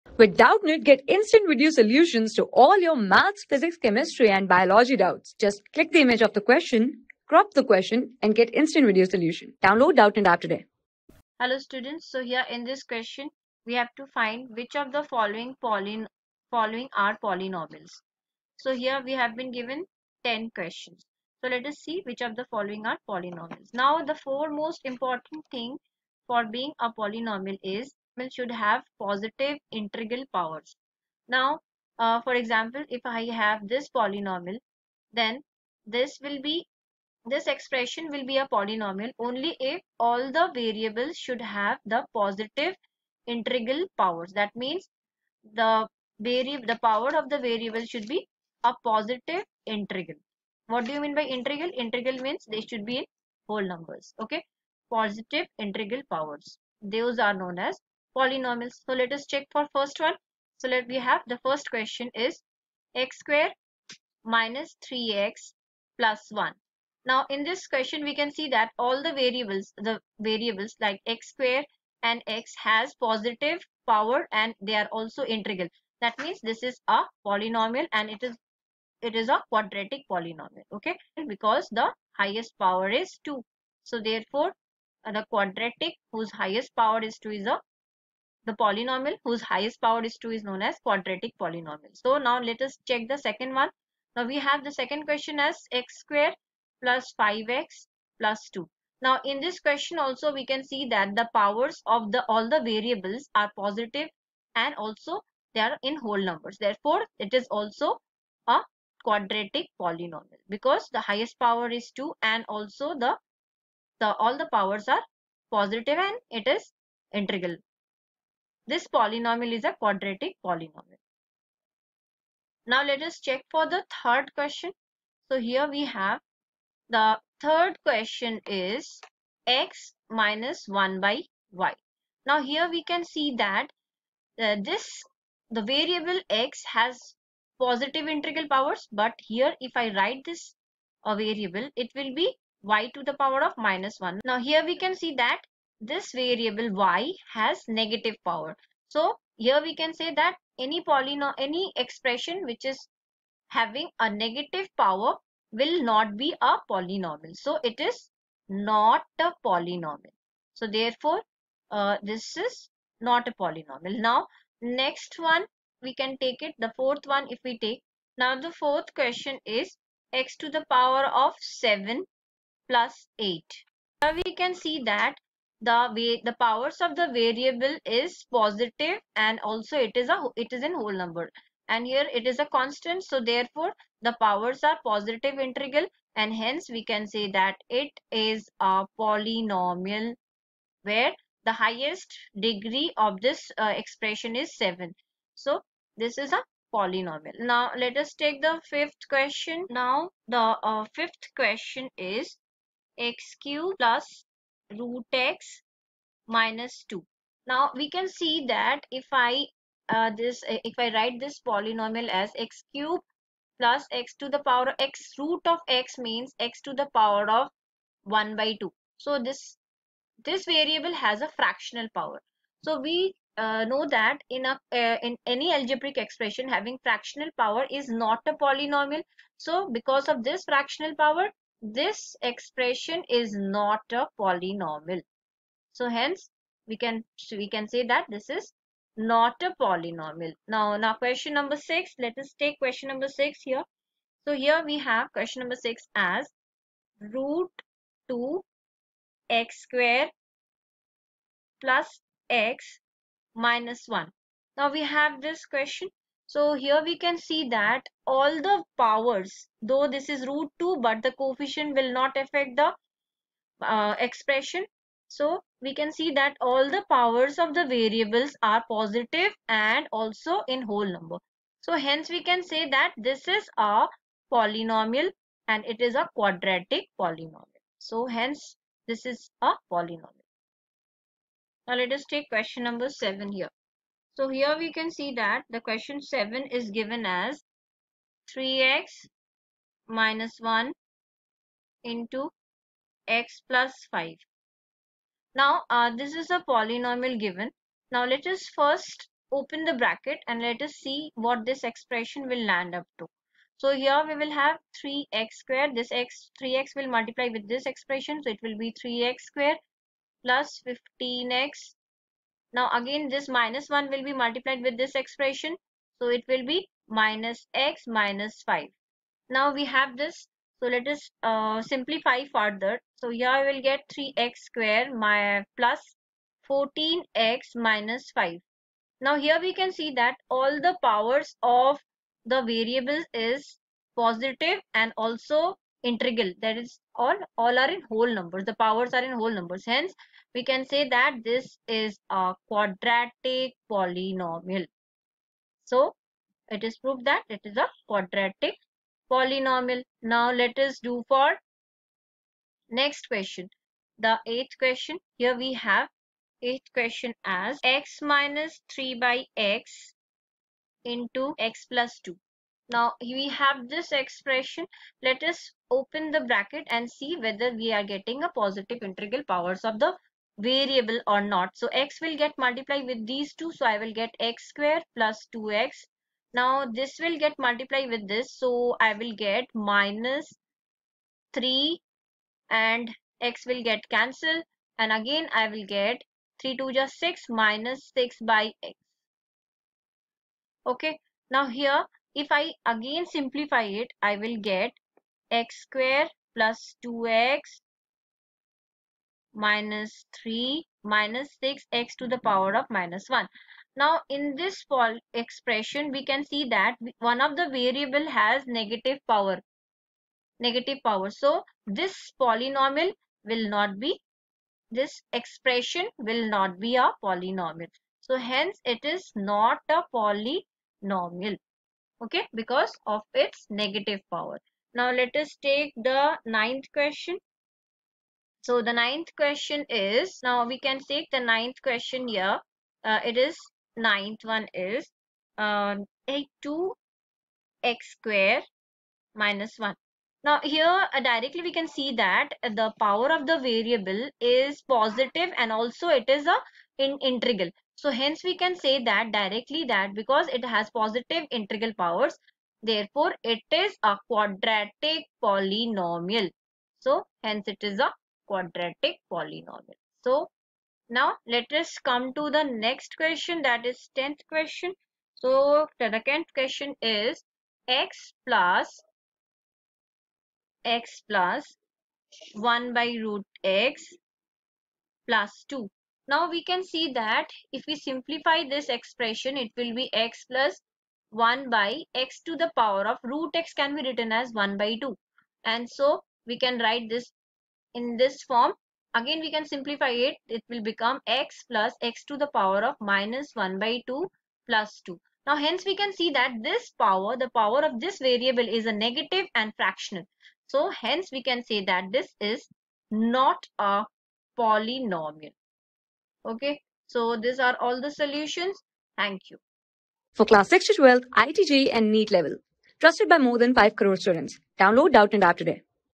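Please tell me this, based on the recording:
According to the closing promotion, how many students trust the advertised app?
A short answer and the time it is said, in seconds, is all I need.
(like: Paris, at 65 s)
more than 5 crore, at 513 s.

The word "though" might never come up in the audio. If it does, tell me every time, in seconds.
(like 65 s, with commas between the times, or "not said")
259 s.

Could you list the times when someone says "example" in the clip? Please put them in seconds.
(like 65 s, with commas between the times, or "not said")
32 s.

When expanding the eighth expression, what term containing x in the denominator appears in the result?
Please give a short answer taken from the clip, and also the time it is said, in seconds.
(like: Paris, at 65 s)
minus 6 by x, at 387 s.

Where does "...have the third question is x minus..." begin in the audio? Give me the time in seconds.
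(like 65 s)
125 s.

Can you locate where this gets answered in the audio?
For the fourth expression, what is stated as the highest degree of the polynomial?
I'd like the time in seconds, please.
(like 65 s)
191 s.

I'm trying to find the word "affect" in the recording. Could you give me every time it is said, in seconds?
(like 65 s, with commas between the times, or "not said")
262 s.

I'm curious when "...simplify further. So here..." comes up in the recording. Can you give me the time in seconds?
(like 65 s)
321 s.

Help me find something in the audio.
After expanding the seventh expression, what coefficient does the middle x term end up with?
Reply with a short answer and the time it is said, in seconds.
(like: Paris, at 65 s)
14, at 326 s.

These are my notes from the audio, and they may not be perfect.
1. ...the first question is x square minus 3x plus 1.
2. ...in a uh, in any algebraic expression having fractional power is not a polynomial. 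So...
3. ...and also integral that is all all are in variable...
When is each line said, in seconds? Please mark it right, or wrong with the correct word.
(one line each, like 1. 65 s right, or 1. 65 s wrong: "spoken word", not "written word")
1. 61 s right
2. 224 s right
3. 334 s wrong: "whole", not "variable".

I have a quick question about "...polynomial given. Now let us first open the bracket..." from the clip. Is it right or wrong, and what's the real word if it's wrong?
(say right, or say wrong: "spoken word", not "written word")
right.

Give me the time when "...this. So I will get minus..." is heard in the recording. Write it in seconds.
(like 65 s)
378 s.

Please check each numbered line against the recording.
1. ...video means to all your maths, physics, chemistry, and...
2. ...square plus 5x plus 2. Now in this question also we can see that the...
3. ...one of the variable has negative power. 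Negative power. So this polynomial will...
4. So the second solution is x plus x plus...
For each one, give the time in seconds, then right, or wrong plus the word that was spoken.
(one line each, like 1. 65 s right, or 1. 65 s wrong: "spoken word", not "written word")
1. 1 s wrong: "solutions", not "means"
2. 95 s right
3. 406 s right
4. 465 s wrong: "question", not "solution".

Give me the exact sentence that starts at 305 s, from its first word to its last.
This x 3x will multiply with this expression.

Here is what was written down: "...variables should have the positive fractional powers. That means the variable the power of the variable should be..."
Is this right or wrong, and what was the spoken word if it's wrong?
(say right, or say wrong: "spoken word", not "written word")
wrong: "integral", not "fractional".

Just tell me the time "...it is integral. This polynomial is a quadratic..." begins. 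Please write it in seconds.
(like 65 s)
116 s.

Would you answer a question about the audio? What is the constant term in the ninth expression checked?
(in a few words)
1.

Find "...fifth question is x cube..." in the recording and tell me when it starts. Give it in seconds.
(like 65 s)
200 s.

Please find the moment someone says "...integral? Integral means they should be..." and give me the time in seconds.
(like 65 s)
51 s.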